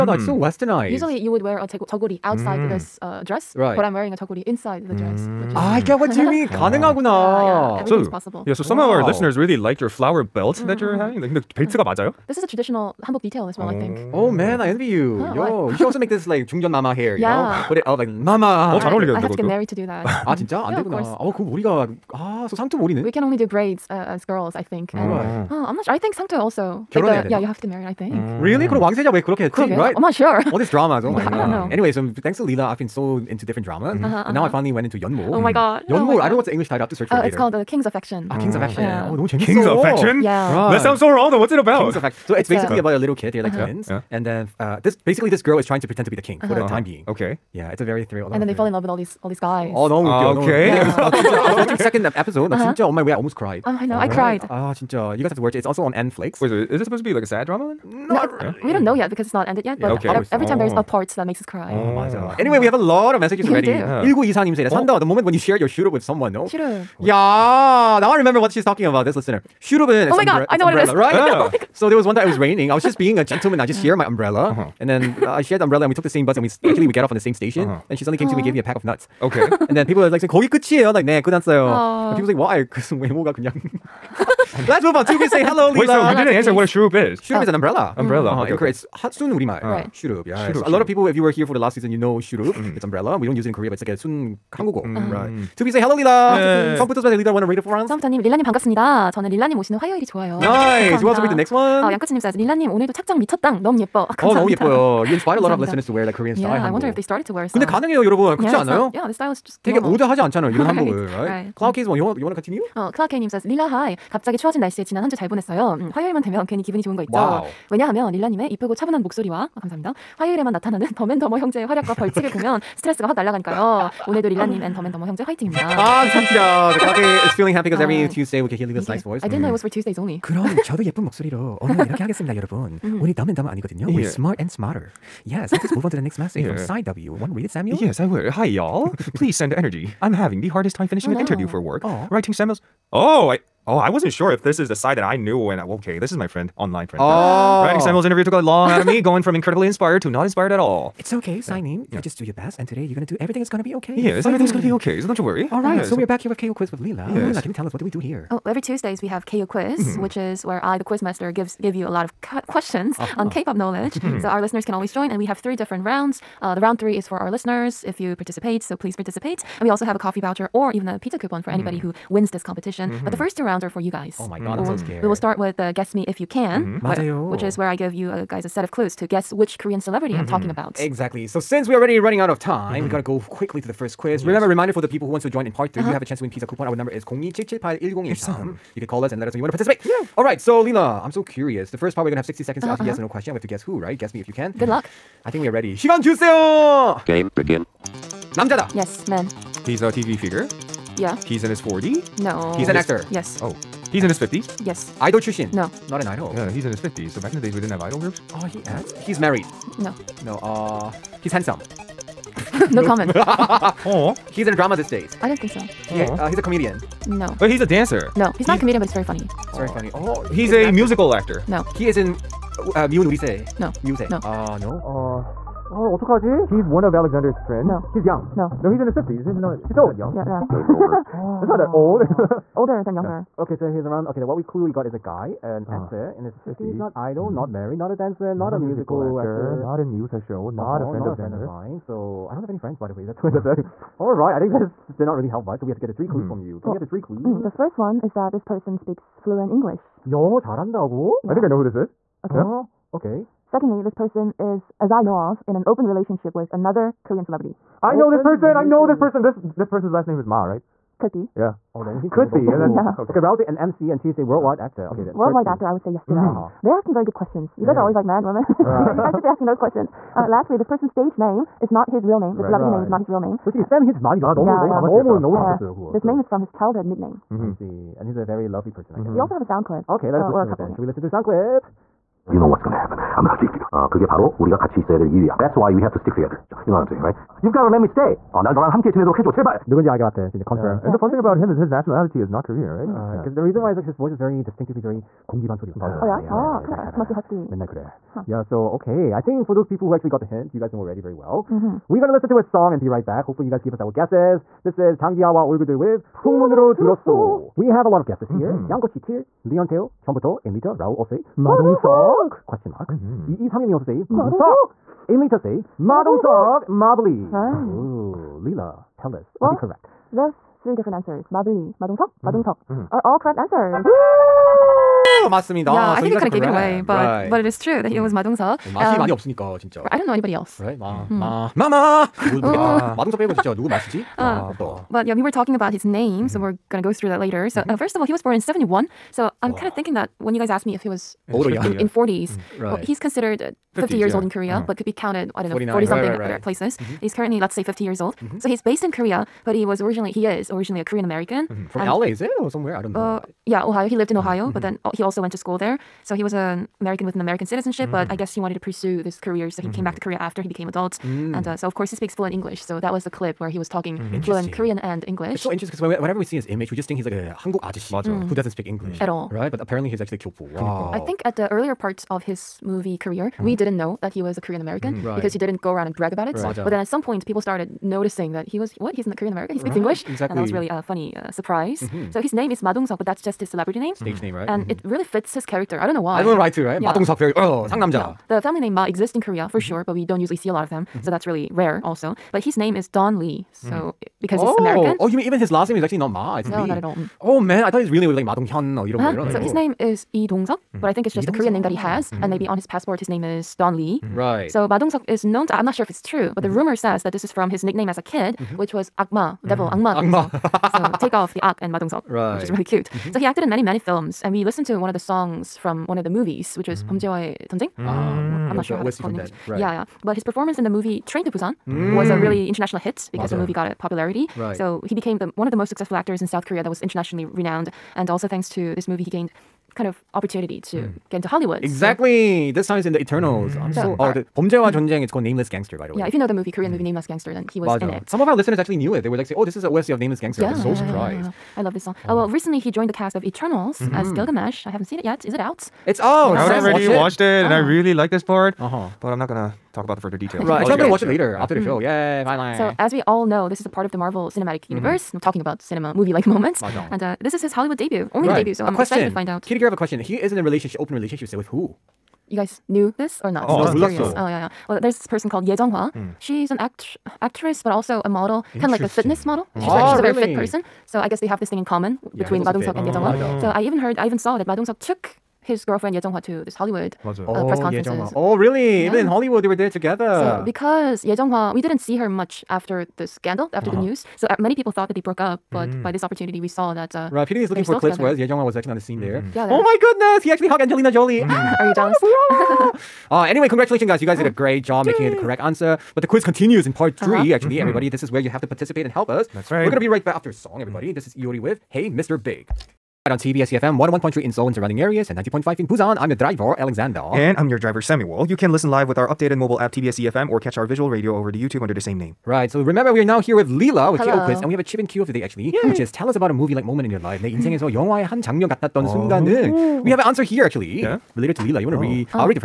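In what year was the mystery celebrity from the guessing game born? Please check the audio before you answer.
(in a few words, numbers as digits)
1971.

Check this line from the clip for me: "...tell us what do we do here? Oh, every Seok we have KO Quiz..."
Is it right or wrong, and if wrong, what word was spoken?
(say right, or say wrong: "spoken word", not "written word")
wrong: "Tuesdays", not "Seok".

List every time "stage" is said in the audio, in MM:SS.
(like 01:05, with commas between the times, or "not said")
04:30, 06:23.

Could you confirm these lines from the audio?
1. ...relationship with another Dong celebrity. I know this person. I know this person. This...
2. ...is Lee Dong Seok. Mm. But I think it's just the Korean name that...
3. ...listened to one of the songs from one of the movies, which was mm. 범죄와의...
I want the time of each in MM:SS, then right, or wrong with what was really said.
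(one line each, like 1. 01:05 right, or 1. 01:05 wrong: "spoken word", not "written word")
1. 04:15 wrong: "Korean", not "Dong"
2. 06:39 right
3. 06:54 right.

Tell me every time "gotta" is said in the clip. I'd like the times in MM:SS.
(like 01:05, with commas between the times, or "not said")
03:02, 04:47.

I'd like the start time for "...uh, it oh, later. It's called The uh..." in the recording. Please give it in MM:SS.
00:37.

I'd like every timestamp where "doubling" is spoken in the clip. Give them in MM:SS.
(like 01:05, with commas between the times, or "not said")
not said.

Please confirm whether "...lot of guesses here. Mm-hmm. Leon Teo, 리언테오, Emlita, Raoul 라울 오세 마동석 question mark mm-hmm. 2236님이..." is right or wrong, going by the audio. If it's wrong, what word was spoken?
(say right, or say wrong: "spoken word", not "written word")
right.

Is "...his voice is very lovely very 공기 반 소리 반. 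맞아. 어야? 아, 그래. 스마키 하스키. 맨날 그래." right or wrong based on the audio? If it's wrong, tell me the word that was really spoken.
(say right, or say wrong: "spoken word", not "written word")
wrong: "distinctively", not "lovely".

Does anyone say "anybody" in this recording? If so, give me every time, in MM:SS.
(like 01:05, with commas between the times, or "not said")
02:51, 05:30.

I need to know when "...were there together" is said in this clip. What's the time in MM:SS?
07:59.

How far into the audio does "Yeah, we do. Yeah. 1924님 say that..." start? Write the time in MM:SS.
01:03.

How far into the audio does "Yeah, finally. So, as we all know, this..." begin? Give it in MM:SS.
07:31.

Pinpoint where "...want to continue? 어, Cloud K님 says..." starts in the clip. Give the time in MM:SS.
01:52.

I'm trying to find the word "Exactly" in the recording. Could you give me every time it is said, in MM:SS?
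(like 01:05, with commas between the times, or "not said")
03:00, 06:20, 07:11.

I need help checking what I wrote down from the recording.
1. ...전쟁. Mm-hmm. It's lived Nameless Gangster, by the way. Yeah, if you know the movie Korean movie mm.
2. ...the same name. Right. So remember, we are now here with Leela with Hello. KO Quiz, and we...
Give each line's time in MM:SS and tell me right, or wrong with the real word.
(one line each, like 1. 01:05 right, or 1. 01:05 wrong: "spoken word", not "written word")
1. 07:14 wrong: "called", not "lived"
2. 08:31 right.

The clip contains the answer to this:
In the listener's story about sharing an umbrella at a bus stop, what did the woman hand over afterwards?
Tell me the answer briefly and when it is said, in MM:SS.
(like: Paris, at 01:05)
a pack of nuts, at 01:18.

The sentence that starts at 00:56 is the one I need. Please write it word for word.
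Wait, so is it supposed to be like a sad drama then?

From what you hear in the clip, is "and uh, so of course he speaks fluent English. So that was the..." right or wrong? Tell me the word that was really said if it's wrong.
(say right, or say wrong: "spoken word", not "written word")
right.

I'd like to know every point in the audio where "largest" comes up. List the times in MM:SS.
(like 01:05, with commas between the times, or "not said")
not said.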